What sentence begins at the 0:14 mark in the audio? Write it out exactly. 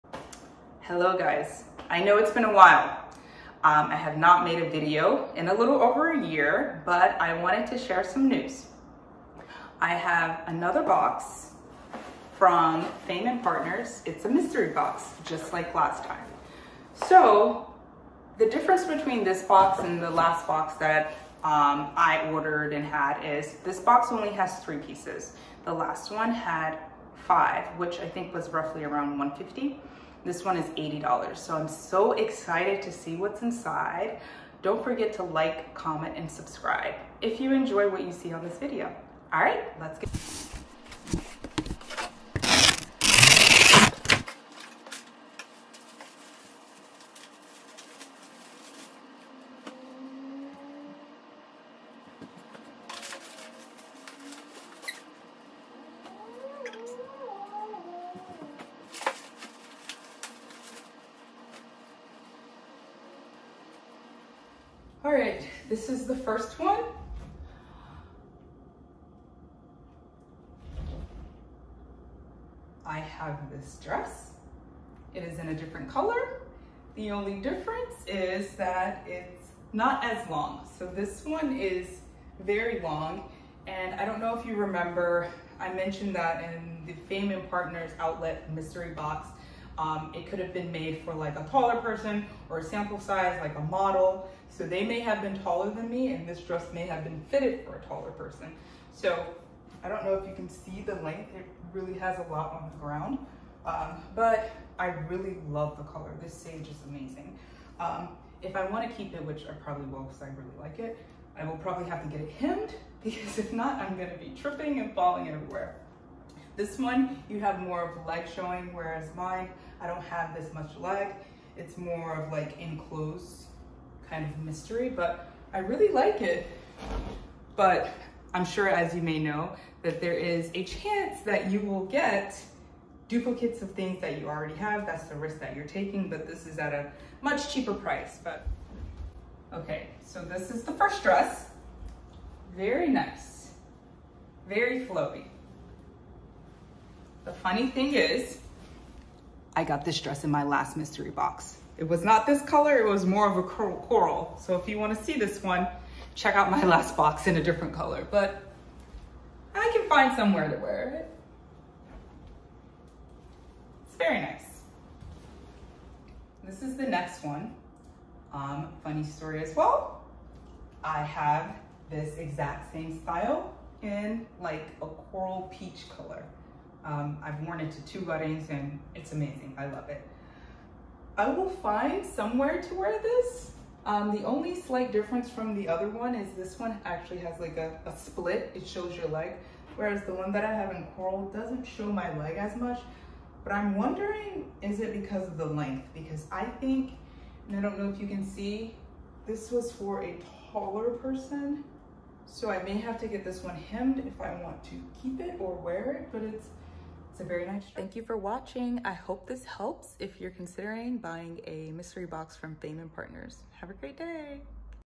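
It's a mystery box, just like last time.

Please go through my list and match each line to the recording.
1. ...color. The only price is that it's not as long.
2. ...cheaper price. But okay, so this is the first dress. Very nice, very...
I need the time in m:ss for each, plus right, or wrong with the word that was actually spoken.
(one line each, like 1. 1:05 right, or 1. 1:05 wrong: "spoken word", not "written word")
1. 1:15 wrong: "difference", not "price"
2. 2:17 right.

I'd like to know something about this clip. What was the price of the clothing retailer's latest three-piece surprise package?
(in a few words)
$80.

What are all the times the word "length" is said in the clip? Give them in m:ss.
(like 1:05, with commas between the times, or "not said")
1:41, 3:15.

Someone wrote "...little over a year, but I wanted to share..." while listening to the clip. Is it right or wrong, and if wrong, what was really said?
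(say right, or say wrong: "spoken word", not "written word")
right.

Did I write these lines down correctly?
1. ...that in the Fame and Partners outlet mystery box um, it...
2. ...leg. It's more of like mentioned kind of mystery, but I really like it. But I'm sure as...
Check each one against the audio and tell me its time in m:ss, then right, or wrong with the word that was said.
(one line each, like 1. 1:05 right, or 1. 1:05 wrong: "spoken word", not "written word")
1. 1:26 right
2. 2:00 wrong: "enclosed", not "mentioned".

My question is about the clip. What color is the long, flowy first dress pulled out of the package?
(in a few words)
sage.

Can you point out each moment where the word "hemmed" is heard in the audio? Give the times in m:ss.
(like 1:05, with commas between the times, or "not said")
1:52, 3:23.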